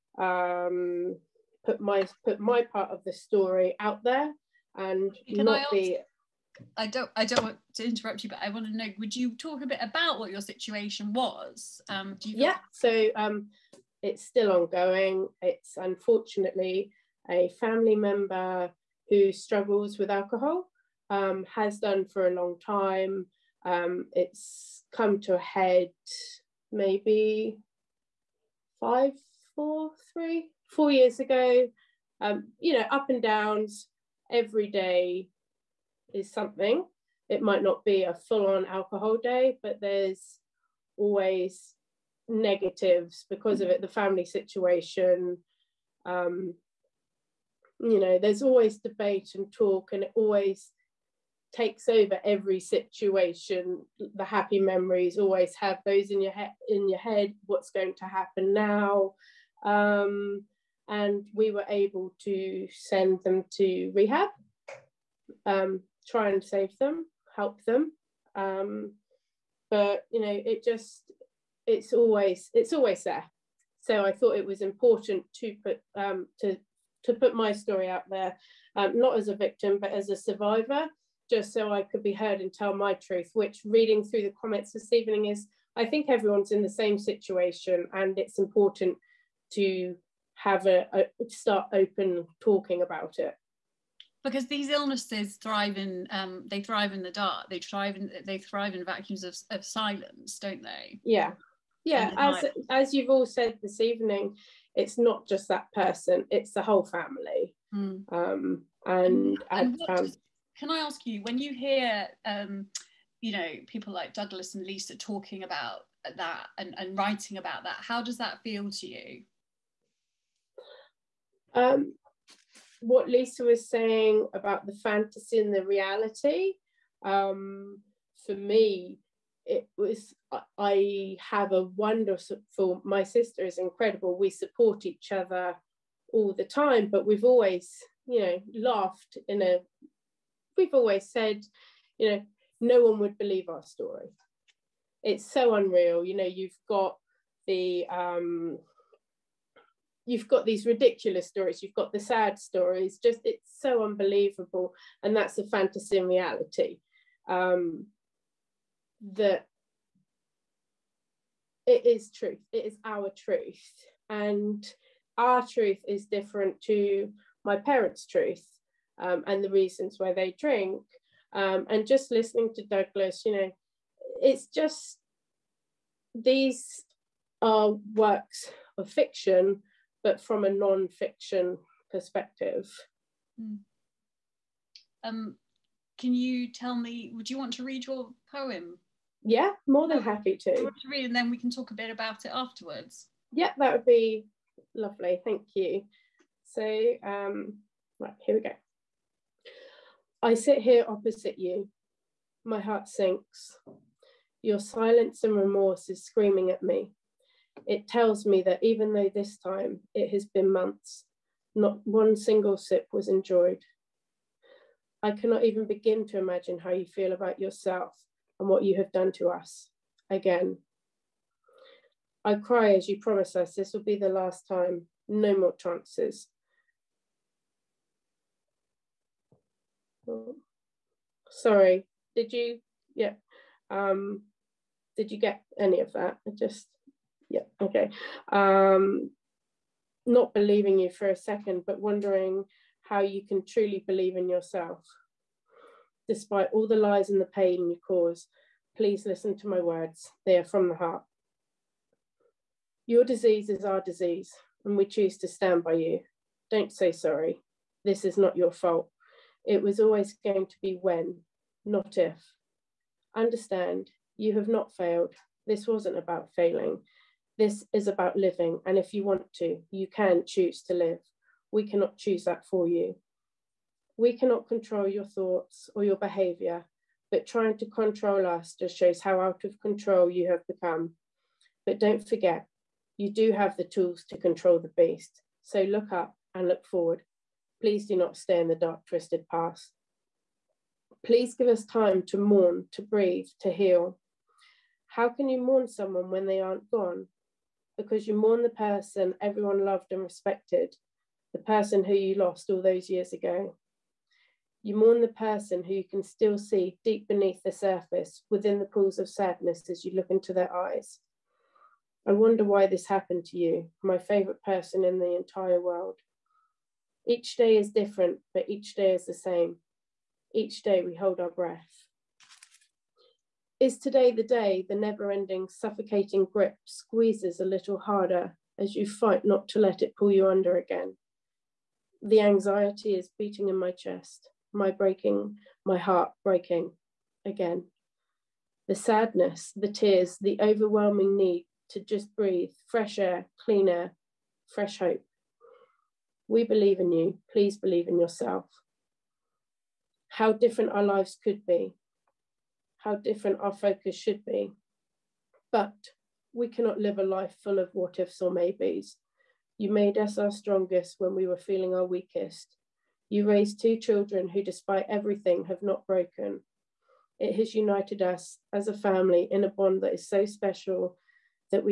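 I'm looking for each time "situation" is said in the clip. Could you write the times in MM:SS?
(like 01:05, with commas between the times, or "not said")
00:10, 00:44, 00:52, 01:26.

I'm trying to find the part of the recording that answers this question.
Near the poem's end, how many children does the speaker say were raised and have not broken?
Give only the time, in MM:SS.
06:03.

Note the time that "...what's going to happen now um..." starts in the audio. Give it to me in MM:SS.
00:57.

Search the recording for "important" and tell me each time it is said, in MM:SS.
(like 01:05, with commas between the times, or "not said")
01:14, 01:28.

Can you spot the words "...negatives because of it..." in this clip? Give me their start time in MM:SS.
00:42.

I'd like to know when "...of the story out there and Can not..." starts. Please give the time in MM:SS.
00:02.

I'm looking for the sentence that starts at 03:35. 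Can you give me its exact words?
I cannot even begin to imagine how you feel about yourself and what you have done to us.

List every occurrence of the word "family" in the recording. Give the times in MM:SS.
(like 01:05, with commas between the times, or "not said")
00:17, 00:43, 01:46, 06:08.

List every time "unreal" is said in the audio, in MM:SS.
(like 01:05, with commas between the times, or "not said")
02:25.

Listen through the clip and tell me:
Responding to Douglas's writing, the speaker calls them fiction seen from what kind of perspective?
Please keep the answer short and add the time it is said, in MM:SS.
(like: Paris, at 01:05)
non-fiction, at 03:00.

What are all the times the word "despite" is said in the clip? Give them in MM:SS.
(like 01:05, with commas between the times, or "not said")
04:06, 06:04.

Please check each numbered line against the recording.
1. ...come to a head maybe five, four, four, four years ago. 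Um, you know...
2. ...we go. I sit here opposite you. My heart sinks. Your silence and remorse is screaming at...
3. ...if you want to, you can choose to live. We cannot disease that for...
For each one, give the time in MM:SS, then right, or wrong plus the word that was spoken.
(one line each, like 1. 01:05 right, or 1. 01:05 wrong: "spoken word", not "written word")
1. 00:24 wrong: "three", not "four"
2. 03:18 right
3. 04:28 wrong: "choose", not "disease".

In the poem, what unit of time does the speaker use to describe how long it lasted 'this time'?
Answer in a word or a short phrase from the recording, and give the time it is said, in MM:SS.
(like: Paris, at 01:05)
months, at 03:30.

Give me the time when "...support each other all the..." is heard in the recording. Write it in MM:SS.
02:14.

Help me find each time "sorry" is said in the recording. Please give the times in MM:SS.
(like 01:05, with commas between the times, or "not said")
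03:51, 04:16.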